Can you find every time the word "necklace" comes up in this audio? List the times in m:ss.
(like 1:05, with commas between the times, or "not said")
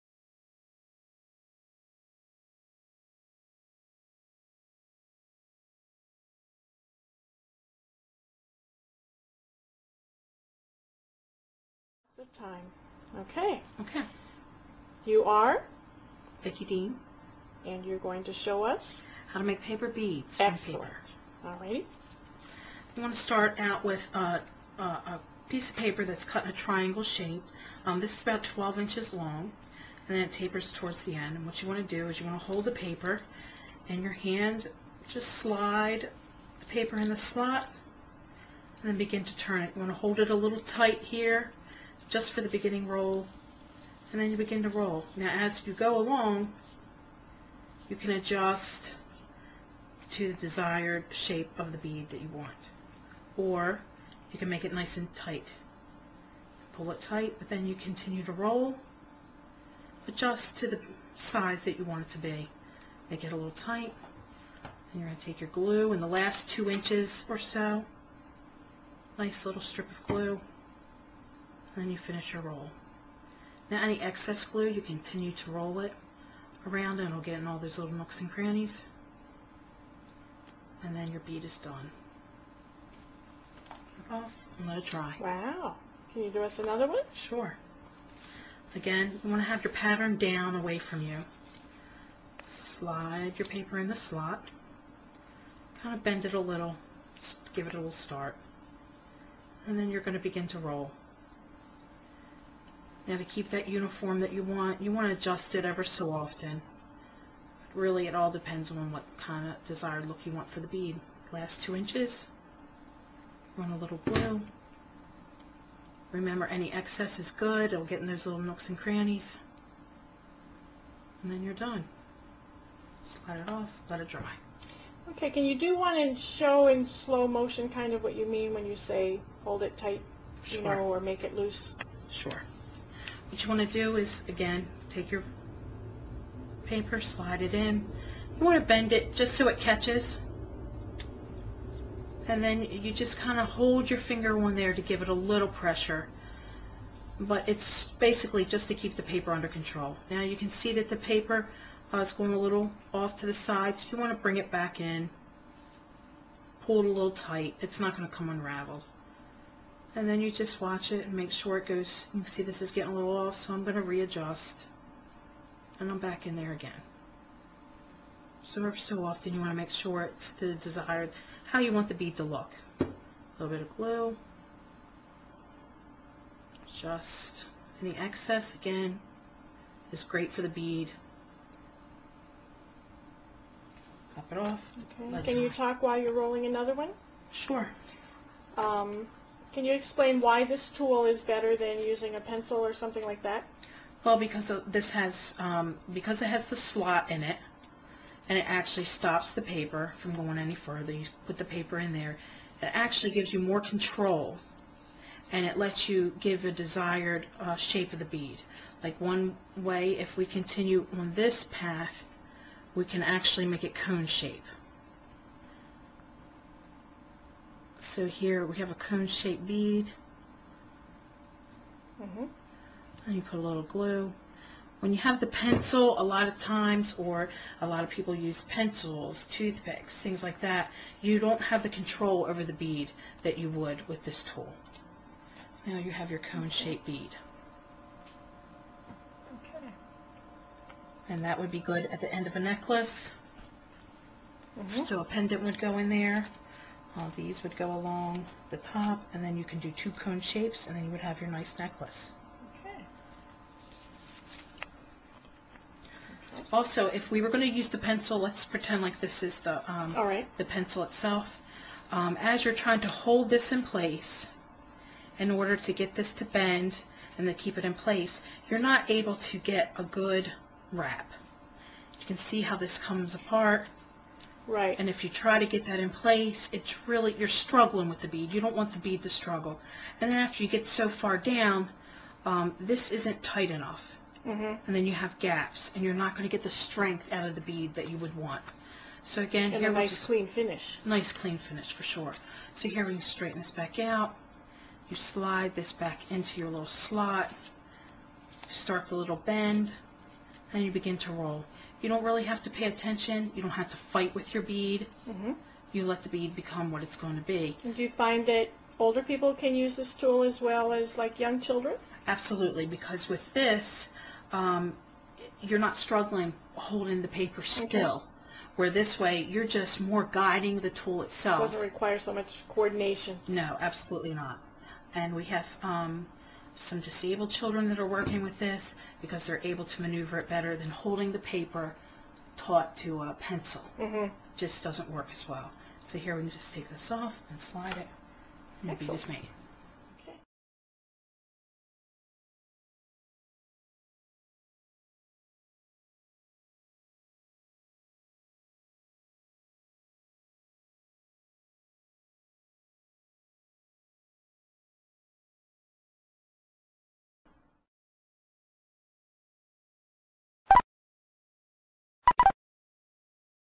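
4:02, 4:11.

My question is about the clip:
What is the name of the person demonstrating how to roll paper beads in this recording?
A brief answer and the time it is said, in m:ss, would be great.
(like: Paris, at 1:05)
Vicki Dean, at 0:16.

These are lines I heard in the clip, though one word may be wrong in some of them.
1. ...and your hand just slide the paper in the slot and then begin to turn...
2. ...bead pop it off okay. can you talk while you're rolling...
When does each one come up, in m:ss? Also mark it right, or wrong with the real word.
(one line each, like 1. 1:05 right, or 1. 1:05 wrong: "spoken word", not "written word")
1. 0:33 right
2. 3:00 right.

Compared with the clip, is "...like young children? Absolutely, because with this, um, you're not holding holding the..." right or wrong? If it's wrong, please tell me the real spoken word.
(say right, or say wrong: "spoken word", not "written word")
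wrong: "struggling", not "holding".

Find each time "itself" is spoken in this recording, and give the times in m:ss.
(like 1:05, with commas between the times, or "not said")
4:20, 5:21.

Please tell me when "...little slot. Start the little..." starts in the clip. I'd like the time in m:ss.
4:56.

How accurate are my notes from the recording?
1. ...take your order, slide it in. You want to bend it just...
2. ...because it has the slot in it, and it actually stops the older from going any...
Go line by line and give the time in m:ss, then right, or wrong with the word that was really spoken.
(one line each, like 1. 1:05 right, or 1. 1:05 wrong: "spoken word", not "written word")
1. 2:14 wrong: "paper", not "order"
2. 3:15 wrong: "paper", not "older".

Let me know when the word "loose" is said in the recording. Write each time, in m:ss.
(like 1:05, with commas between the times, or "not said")
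2:11.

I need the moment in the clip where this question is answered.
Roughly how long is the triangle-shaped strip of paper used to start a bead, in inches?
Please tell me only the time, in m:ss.
0:28.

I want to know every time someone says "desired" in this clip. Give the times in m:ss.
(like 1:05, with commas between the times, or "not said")
0:50, 1:49, 2:50, 3:26.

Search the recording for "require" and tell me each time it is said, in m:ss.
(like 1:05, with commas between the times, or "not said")
5:21.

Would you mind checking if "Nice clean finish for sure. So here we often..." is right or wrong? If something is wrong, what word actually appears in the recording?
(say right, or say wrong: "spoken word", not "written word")
wrong: "straighten", not "often".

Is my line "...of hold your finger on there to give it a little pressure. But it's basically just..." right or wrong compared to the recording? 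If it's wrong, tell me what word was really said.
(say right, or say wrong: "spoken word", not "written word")
right.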